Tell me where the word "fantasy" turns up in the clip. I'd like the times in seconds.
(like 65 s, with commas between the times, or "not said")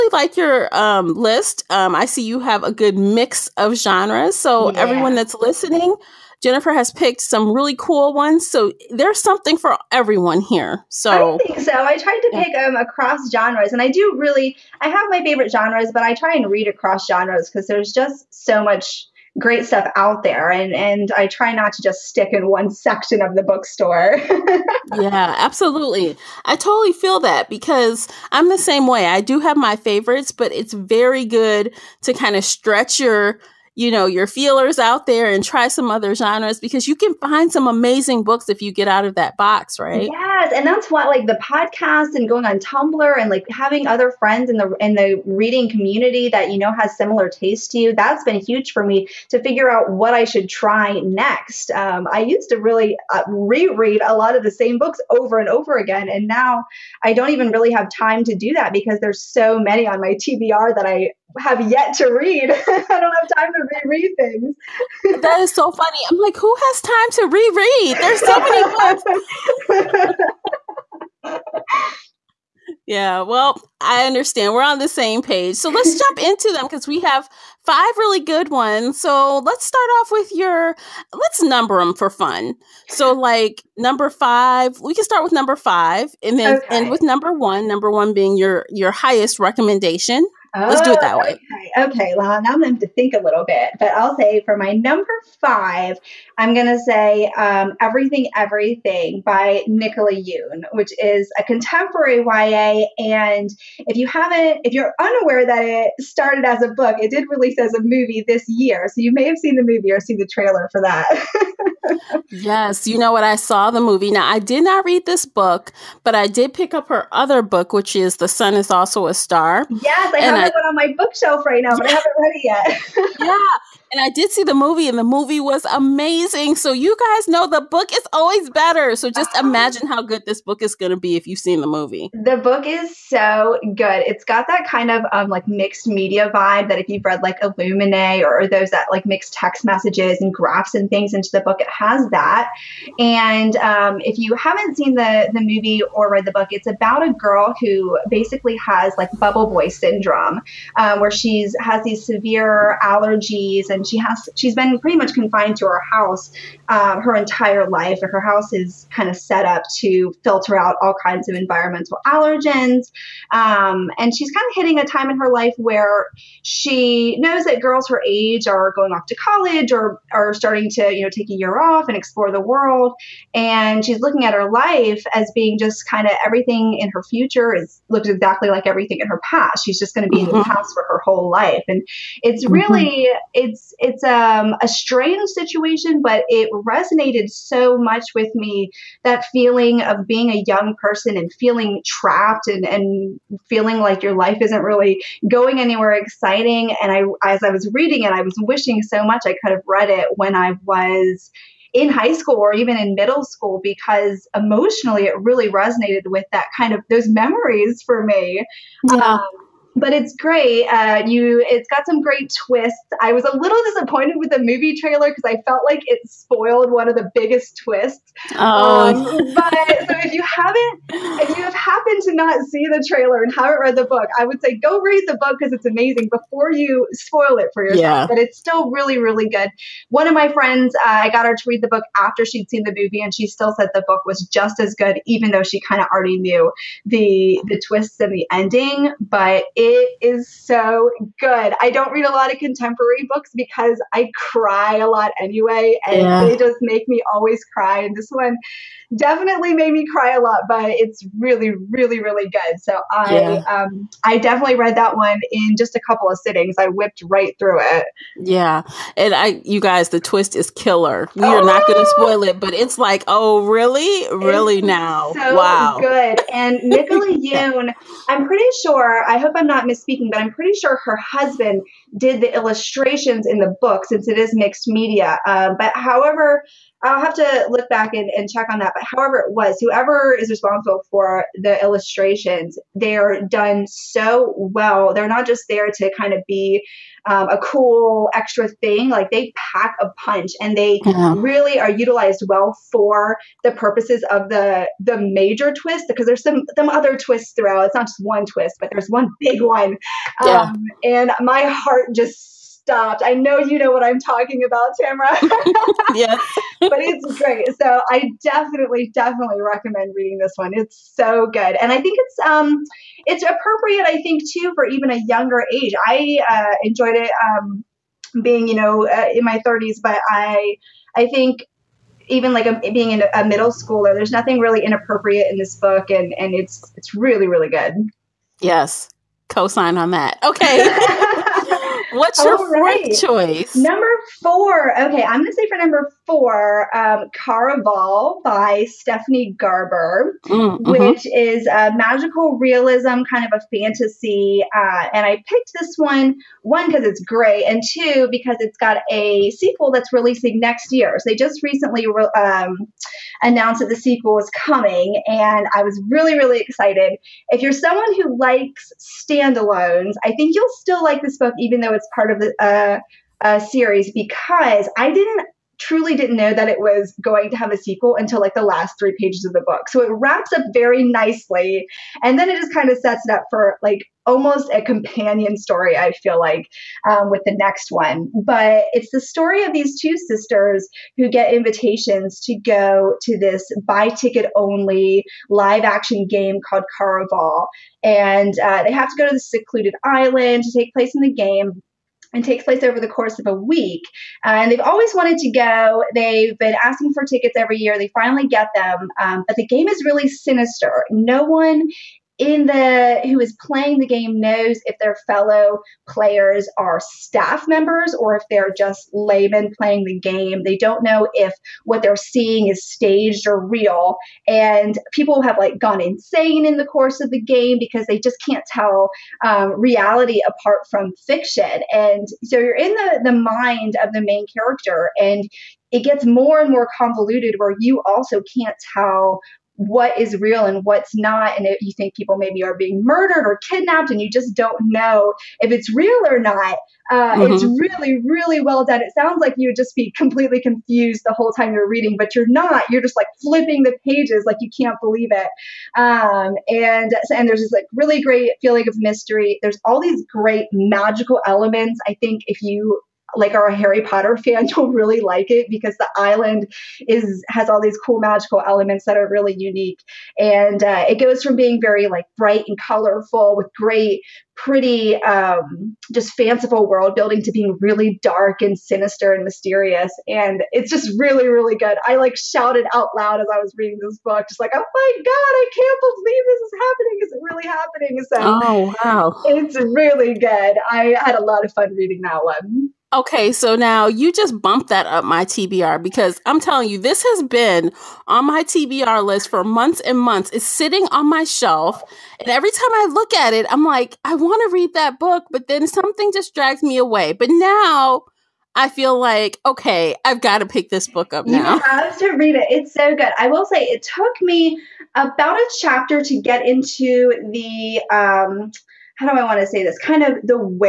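343 s.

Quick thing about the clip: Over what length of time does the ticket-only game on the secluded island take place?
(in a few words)
a week.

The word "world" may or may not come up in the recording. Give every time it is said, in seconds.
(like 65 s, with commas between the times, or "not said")
172 s, 466 s.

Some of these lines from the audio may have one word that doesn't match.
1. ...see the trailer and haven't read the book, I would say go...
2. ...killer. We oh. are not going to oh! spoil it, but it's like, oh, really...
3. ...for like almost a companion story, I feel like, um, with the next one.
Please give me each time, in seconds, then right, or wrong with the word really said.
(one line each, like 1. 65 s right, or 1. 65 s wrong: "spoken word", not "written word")
1. 222 s right
2. 260 s right
3. 373 s right.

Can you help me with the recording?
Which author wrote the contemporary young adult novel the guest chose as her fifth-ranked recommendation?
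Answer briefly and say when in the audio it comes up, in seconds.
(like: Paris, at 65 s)
Nicola Yoon, at 99 s.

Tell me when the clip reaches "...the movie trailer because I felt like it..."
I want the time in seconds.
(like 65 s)
214 s.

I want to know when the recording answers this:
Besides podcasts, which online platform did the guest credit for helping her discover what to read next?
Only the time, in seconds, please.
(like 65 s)
42 s.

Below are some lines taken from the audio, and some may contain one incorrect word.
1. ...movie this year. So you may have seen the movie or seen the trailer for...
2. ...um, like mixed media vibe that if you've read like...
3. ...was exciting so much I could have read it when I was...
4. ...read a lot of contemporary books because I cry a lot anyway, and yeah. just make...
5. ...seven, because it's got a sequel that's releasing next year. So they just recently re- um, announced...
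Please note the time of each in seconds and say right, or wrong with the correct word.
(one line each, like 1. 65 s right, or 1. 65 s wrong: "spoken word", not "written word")
1. 107 s right
2. 135 s right
3. 198 s wrong: "wishing", not "exciting"
4. 241 s right
5. 347 s wrong: "two", not "seven".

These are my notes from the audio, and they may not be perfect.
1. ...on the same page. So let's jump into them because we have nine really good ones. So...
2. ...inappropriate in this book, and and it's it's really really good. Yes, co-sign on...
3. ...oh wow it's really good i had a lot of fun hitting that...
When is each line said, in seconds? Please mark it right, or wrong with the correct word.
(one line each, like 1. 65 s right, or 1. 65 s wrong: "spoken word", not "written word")
1. 74 s wrong: "five", not "nine"
2. 324 s right
3. 478 s wrong: "reading", not "hitting".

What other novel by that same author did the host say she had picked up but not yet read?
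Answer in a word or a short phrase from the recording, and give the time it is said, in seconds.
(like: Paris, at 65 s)
The Sun is Also a Star, at 118 s.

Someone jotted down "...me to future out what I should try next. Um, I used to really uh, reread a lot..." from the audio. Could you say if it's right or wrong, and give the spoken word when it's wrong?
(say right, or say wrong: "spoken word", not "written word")
wrong: "figure", not "future".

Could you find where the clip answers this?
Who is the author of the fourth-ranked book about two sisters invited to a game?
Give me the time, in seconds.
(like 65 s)
338 s.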